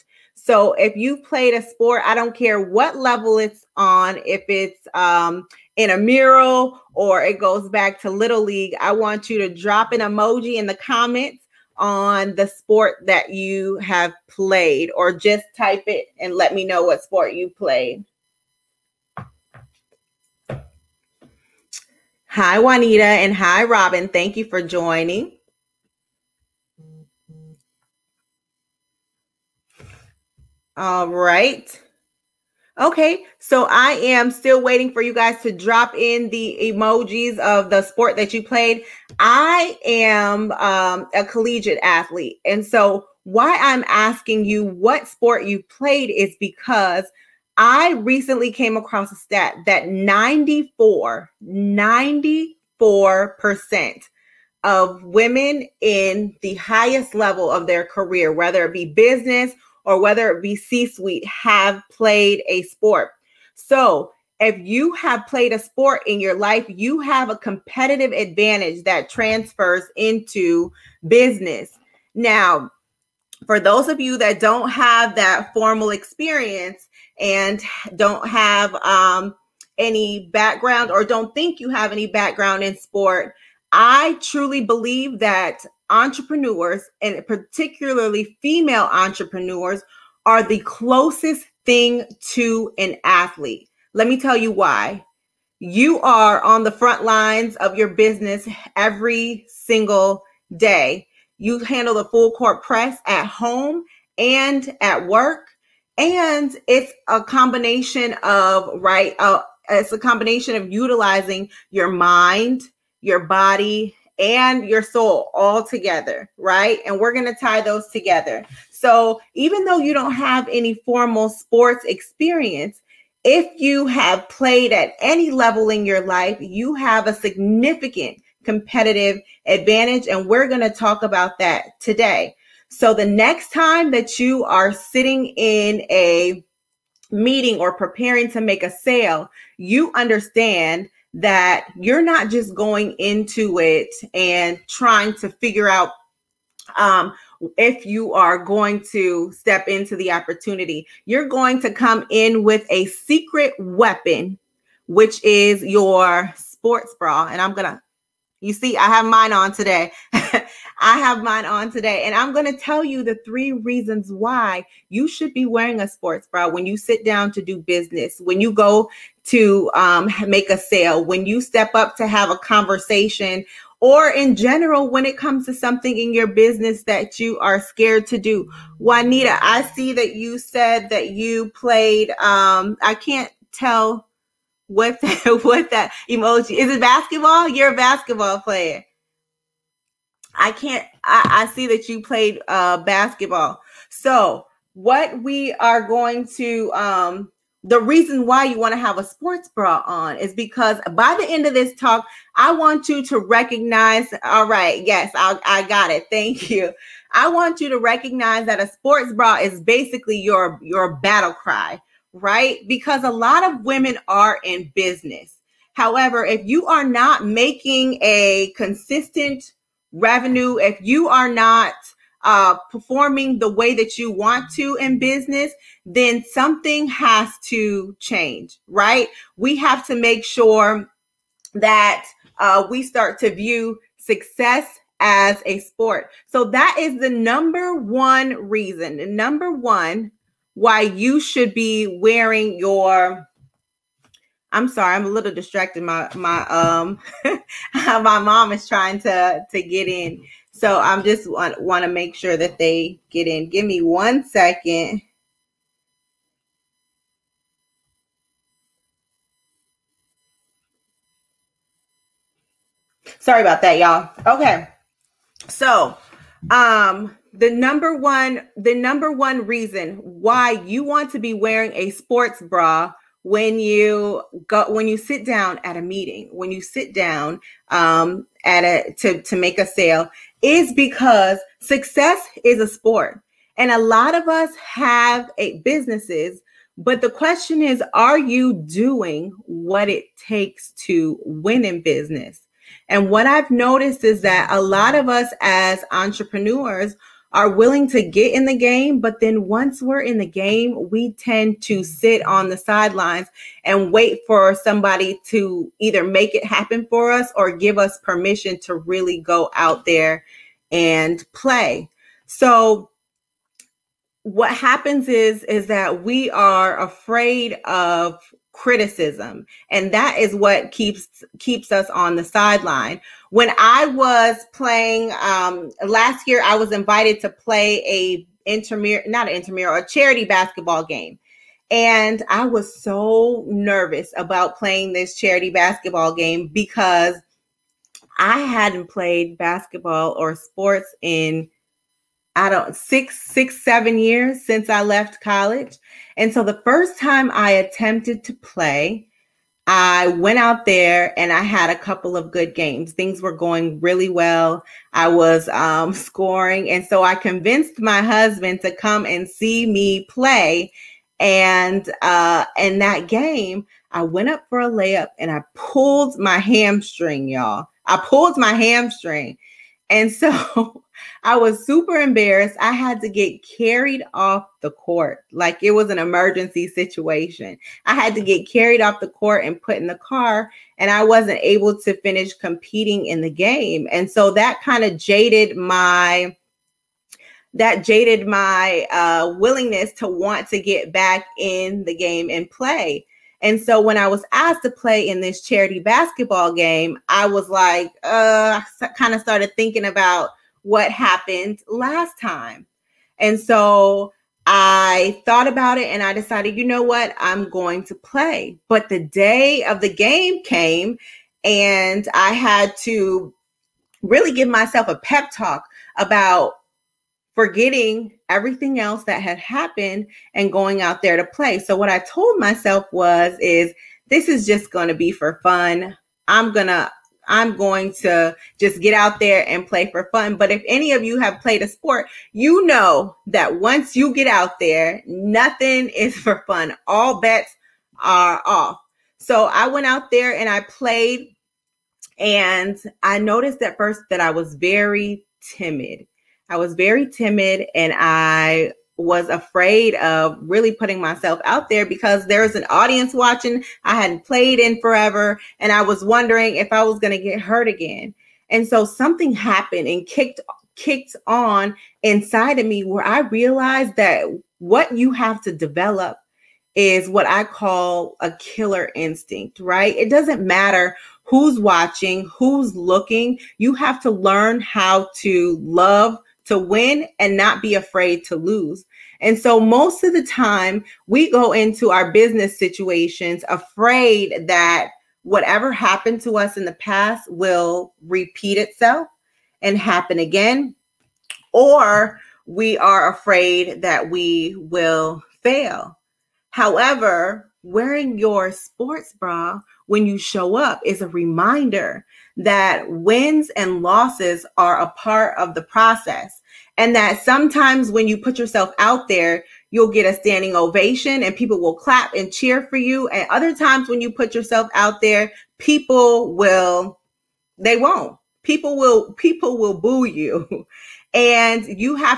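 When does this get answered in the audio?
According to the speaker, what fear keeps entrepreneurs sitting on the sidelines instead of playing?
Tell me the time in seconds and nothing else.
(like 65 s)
318 s.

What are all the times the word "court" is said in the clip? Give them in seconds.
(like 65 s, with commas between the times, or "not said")
102 s, 374 s, 379 s.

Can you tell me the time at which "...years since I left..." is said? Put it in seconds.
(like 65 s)
343 s.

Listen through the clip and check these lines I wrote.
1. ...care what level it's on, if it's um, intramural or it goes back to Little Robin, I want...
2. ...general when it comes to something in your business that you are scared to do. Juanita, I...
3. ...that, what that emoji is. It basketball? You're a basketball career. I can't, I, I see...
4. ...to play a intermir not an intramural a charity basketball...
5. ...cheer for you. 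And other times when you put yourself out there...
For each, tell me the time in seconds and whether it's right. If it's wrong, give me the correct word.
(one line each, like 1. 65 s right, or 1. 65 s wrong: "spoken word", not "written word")
1. 2 s wrong: "League", not "Robin"
2. 174 s right
3. 185 s wrong: "player", not "career"
4. 327 s right
5. 512 s right.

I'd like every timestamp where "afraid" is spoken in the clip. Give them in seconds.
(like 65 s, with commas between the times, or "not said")
316 s, 449 s, 477 s, 483 s, 493 s.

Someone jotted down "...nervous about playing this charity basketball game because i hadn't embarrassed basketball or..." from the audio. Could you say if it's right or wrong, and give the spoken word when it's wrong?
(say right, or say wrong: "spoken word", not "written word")
wrong: "played", not "embarrassed".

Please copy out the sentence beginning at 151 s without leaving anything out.
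You're going to come in with a secret weapon, which is your sports bra.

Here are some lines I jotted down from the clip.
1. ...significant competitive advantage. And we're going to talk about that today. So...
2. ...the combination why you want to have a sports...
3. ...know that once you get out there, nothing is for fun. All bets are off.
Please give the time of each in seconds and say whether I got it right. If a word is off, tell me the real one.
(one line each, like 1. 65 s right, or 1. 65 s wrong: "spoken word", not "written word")
1. 127 s right
2. 197 s wrong: "reason", not "combination"
3. 432 s right.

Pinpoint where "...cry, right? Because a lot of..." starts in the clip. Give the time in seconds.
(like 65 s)
211 s.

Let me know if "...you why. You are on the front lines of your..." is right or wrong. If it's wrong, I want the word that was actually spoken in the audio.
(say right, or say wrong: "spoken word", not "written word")
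right.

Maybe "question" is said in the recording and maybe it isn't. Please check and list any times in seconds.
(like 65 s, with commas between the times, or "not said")
287 s.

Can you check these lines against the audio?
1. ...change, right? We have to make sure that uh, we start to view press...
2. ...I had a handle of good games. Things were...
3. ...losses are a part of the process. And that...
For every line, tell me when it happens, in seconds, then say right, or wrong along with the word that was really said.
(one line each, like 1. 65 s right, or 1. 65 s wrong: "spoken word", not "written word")
1. 227 s wrong: "success", not "press"
2. 351 s wrong: "couple", not "handle"
3. 503 s right.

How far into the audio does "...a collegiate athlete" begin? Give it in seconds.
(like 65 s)
41 s.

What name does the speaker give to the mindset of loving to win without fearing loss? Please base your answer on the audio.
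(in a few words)
killer instinct.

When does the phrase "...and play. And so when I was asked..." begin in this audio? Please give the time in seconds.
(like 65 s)
392 s.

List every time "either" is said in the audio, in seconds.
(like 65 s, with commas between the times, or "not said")
305 s.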